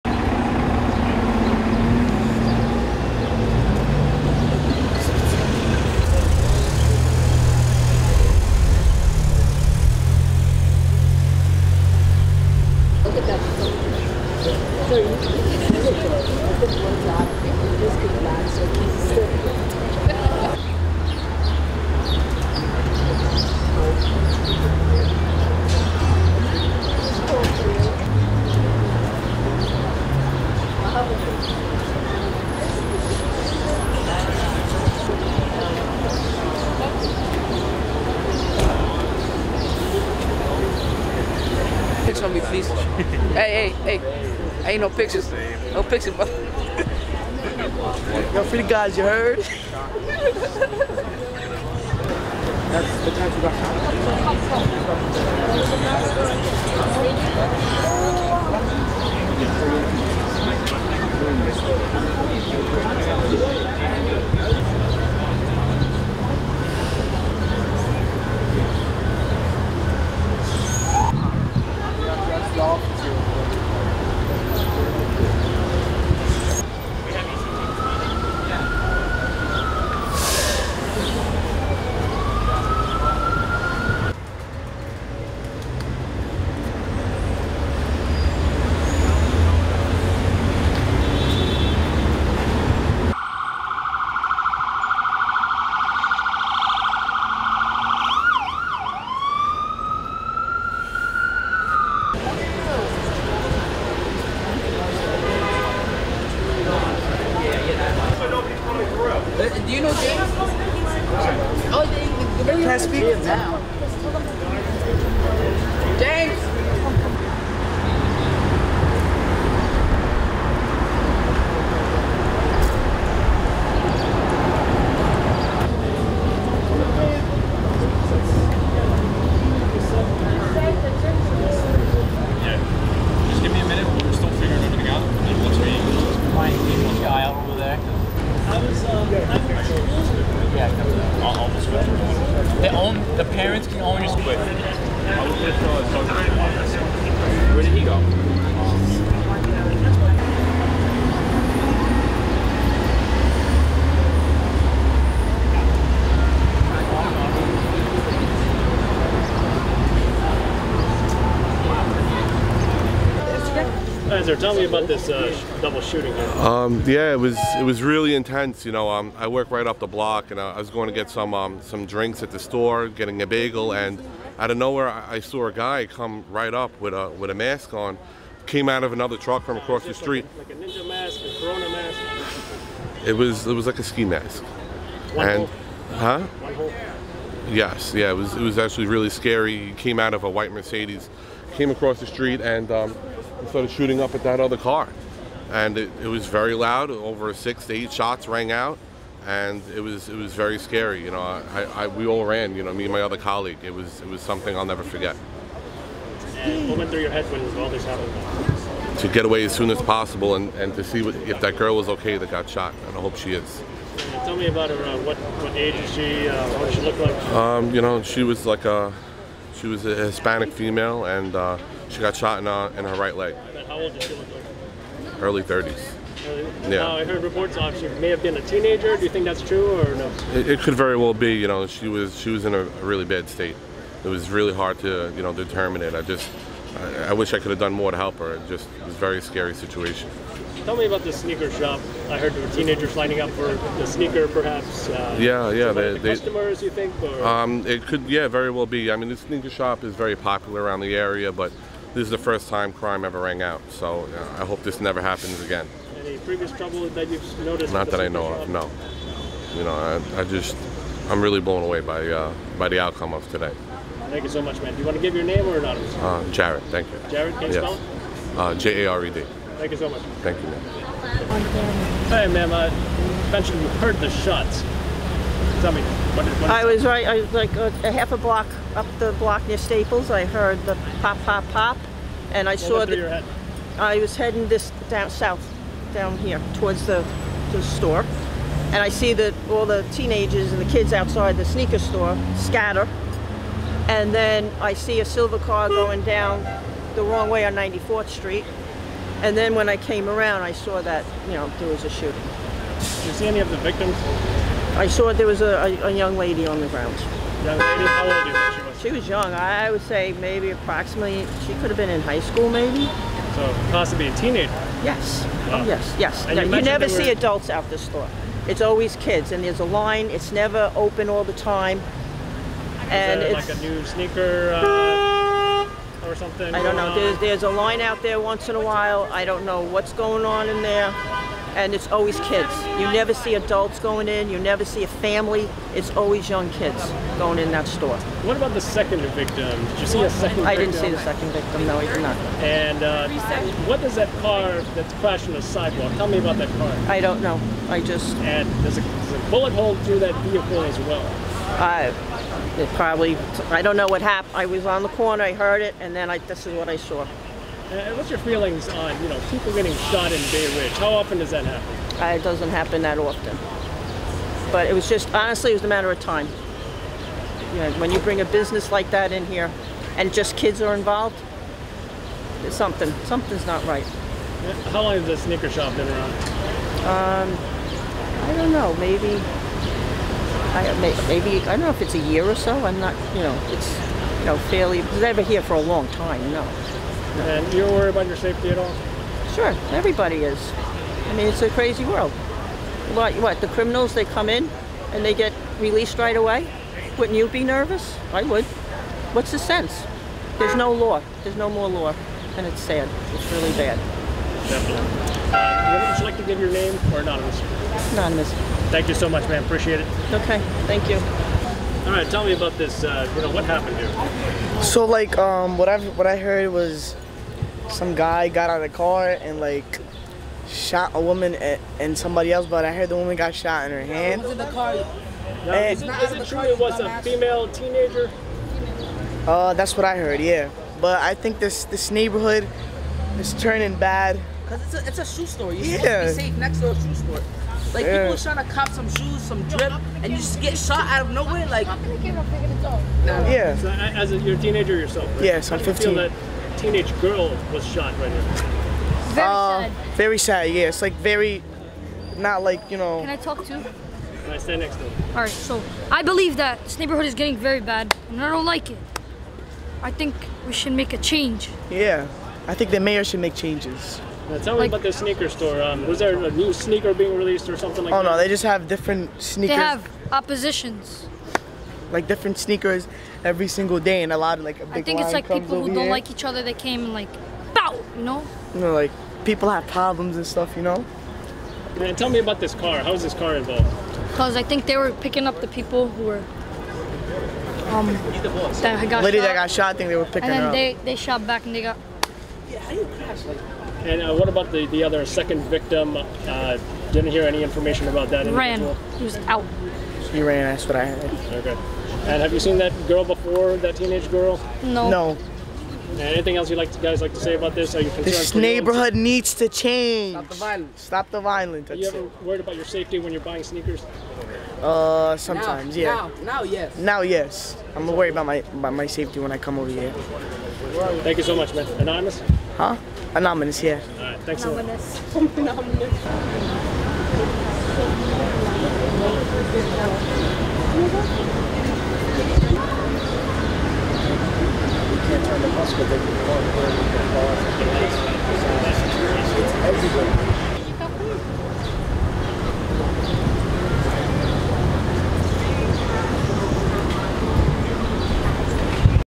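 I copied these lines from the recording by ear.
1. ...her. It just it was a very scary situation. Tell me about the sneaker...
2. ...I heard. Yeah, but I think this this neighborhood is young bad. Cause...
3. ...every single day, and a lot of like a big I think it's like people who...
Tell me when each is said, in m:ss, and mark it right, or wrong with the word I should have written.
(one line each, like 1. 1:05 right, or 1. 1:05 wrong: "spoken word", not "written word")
1. 3:58 right
2. 7:09 wrong: "turning", not "young"
3. 7:53 right.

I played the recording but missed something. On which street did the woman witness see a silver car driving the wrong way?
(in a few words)
94th Street.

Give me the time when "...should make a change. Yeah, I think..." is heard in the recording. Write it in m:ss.
7:40.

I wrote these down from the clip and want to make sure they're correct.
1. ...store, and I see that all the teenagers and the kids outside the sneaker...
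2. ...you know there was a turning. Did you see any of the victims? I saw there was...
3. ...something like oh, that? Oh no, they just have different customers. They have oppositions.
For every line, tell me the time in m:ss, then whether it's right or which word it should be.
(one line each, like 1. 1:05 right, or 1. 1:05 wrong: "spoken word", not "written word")
1. 4:47 right
2. 5:01 wrong: "shooting", not "turning"
3. 7:47 wrong: "sneakers", not "customers".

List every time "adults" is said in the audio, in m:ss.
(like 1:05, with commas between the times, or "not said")
5:17, 5:33.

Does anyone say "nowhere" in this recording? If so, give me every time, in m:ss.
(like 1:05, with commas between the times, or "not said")
2:54, 7:21.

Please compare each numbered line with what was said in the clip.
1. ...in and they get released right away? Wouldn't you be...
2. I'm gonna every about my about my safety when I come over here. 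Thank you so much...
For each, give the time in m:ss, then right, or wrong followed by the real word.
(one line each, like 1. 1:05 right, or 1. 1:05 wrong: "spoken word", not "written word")
1. 6:34 right
2. 8:37 wrong: "worry", not "every".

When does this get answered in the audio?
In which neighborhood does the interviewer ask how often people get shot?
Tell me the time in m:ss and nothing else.
6:00.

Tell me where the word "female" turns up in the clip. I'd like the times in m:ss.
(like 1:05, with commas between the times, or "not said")
3:40, 7:07.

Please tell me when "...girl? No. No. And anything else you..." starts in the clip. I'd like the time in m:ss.
8:24.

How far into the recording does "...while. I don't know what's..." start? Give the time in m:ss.
5:28.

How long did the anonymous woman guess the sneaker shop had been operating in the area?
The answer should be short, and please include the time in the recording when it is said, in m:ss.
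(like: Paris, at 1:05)
a year or so, at 6:21.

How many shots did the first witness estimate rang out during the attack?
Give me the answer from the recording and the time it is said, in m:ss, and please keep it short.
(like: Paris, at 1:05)
6 to 8, at 3:17.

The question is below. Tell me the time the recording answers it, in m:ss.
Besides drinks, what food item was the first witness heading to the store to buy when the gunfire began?
2:53.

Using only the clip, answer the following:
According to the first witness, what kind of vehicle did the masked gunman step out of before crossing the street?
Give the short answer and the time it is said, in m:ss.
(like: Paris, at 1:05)
white Mercedes, at 3:10.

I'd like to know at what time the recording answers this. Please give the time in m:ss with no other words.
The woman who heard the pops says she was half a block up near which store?
4:39.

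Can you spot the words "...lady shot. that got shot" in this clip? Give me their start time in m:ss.
8:09.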